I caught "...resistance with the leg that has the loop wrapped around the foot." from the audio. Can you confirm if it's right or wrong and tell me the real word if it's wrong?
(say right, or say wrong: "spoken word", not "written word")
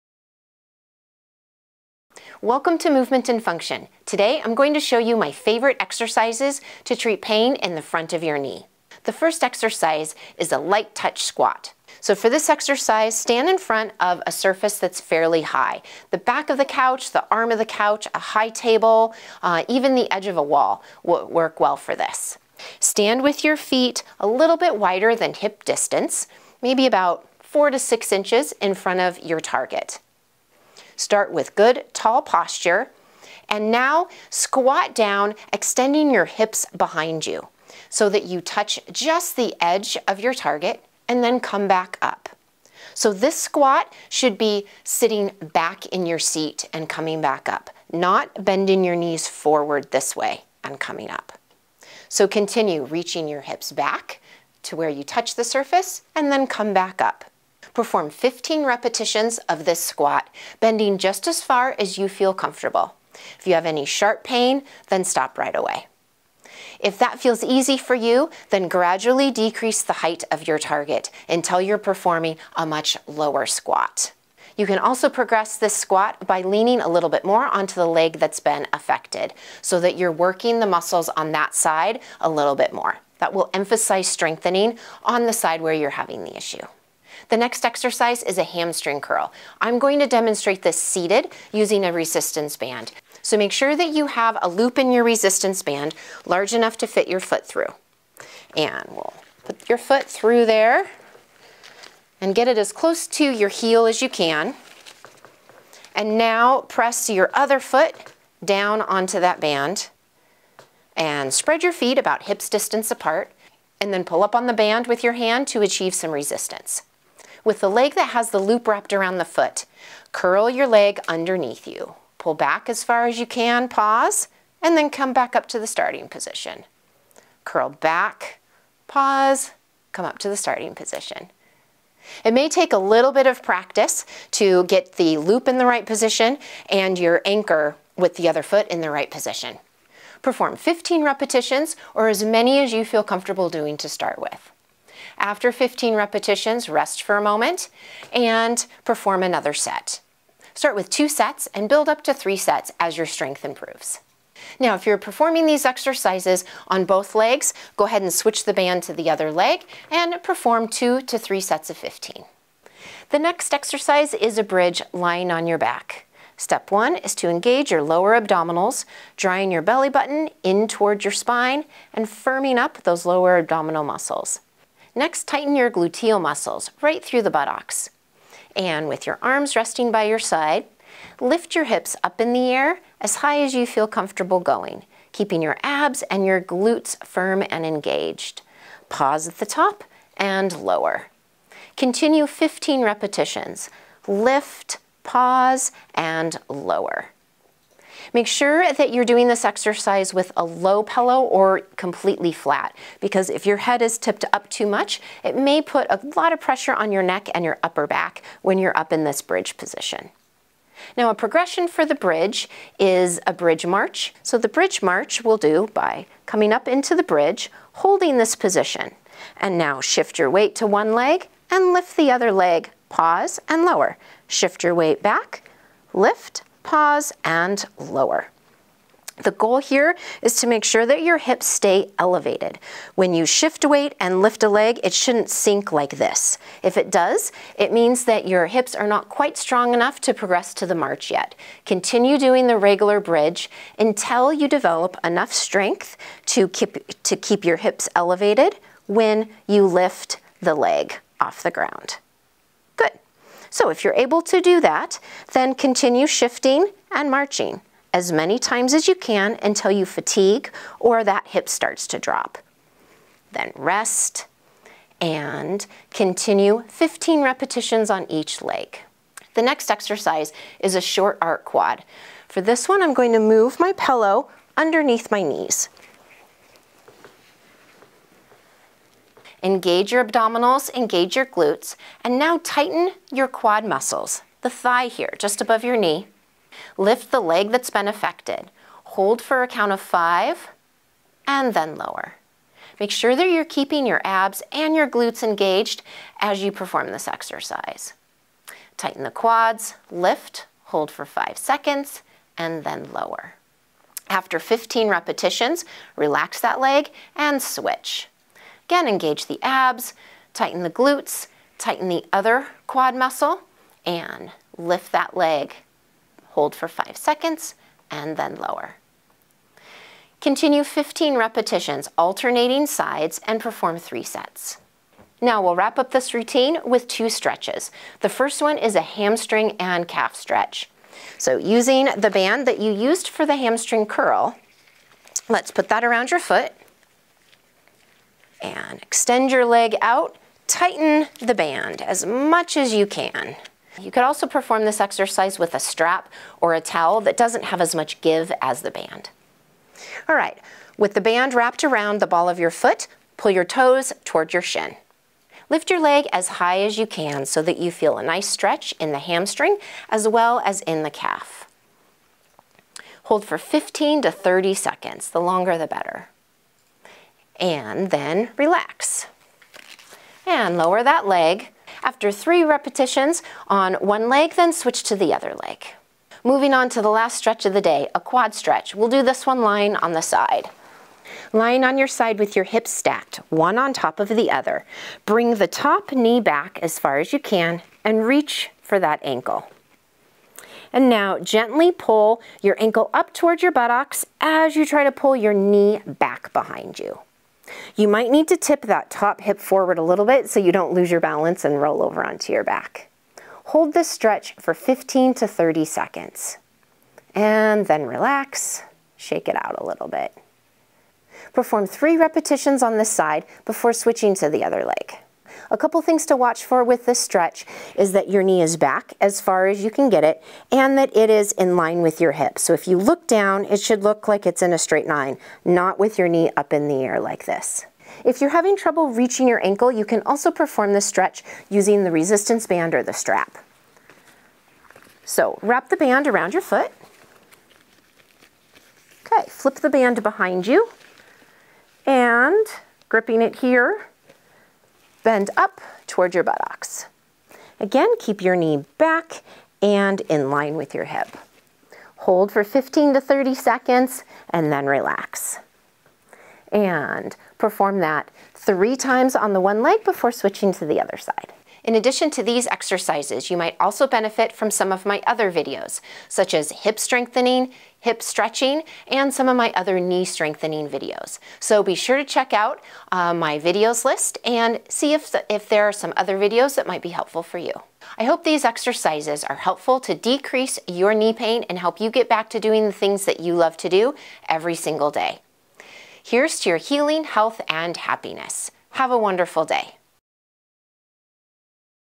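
right.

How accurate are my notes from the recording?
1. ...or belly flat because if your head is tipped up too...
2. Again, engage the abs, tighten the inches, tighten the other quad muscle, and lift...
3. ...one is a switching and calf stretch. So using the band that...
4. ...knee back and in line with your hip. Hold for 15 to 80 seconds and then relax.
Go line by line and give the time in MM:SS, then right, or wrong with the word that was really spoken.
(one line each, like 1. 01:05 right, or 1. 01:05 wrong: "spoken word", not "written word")
1. 03:21 wrong: "completely", not "belly"
2. 05:08 wrong: "glutes", not "inches"
3. 05:28 wrong: "hamstring", not "switching"
4. 07:28 wrong: "30", not "80".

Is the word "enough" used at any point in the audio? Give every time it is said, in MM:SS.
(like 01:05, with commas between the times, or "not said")
01:36, 03:59, 04:05.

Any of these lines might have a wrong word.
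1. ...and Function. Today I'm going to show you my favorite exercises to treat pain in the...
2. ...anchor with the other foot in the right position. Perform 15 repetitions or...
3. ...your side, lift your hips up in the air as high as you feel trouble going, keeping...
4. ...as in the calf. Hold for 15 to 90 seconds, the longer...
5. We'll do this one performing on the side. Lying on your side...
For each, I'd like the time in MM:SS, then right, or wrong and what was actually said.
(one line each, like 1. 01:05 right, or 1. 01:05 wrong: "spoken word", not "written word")
1. 00:03 right
2. 02:17 right
3. 03:00 wrong: "comfortable", not "trouble"
4. 06:00 wrong: "30", not "90"
5. 06:18 wrong: "lying", not "performing".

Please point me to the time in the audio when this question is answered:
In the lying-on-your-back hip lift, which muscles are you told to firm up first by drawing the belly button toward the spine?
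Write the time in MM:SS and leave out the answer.
02:47.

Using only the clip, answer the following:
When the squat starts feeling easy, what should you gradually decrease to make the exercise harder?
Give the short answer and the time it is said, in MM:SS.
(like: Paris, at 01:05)
the height of your target, at 01:10.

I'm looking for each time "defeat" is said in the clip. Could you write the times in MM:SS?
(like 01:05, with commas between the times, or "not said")
not said.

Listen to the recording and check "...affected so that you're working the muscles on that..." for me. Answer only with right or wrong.
right.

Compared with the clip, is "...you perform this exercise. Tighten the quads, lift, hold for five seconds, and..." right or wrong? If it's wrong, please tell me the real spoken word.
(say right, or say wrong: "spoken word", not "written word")
right.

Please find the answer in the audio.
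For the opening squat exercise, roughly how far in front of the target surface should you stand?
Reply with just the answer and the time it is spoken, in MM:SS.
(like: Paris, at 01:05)
4 to 6 inches, at 00:27.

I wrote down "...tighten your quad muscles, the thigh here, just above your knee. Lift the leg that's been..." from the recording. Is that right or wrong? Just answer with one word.
right.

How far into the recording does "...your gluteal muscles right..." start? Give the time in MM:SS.
02:55.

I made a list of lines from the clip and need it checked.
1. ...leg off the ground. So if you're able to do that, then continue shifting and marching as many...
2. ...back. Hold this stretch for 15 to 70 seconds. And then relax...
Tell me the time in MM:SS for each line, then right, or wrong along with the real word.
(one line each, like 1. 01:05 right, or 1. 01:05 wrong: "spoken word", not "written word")
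1. 04:10 right
2. 06:42 wrong: "30", not "70".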